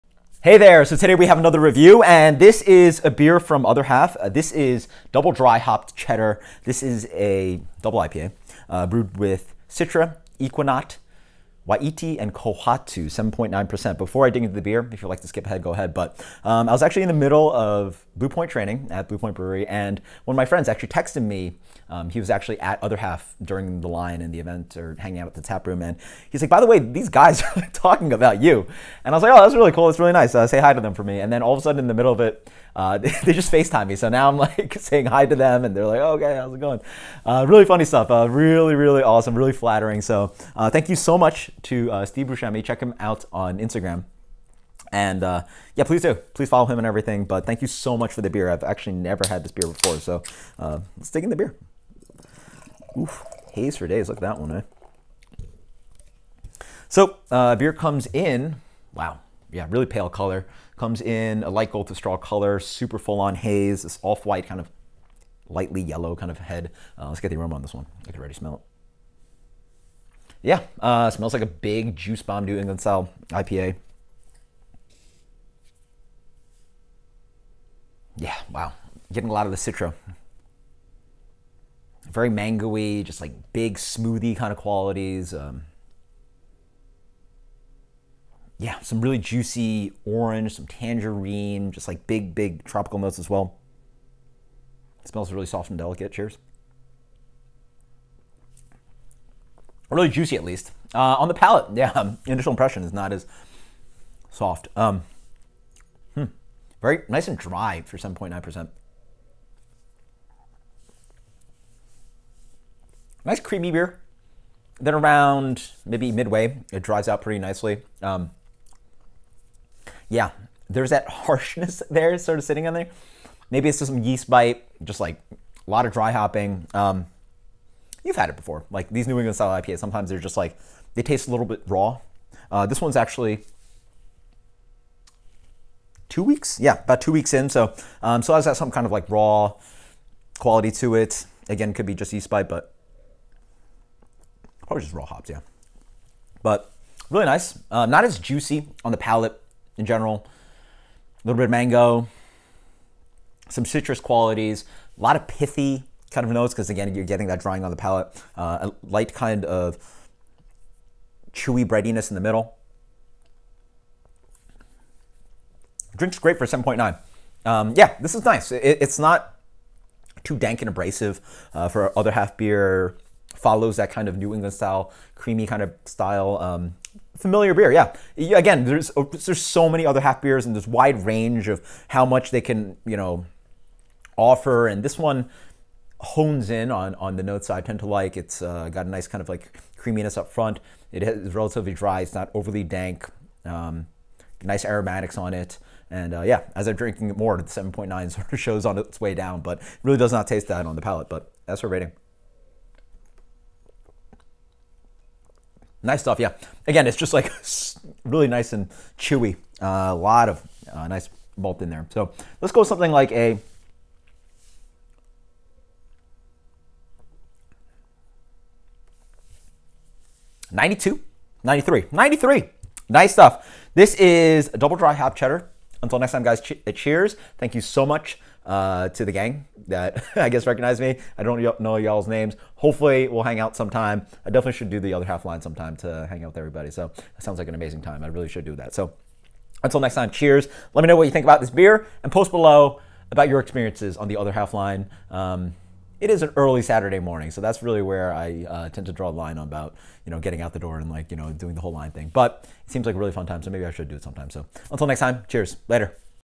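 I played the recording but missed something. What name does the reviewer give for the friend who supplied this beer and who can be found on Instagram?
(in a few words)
Steve Brewscemi.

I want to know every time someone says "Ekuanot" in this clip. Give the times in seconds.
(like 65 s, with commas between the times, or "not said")
10 s.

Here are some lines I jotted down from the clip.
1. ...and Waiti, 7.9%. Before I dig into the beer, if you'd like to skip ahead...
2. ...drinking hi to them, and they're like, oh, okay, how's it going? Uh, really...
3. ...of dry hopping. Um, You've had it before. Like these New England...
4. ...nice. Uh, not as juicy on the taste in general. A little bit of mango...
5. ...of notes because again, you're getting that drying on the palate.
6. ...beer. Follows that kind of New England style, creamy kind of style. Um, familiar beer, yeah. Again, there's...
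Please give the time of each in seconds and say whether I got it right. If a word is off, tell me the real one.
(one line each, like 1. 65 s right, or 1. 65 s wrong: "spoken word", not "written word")
1. 12 s wrong: "Kohatu", not "Waiti"
2. 34 s wrong: "saying", not "drinking"
3. 125 s right
4. 147 s wrong: "palate", not "taste"
5. 156 s right
6. 172 s right.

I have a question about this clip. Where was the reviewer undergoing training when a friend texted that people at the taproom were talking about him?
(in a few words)
Blue Point Brewery.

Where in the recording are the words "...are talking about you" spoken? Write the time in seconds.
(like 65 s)
27 s.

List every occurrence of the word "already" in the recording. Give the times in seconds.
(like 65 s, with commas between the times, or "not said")
68 s.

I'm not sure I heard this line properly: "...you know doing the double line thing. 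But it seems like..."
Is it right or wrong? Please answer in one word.
wrong.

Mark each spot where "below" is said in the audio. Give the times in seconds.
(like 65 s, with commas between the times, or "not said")
242 s.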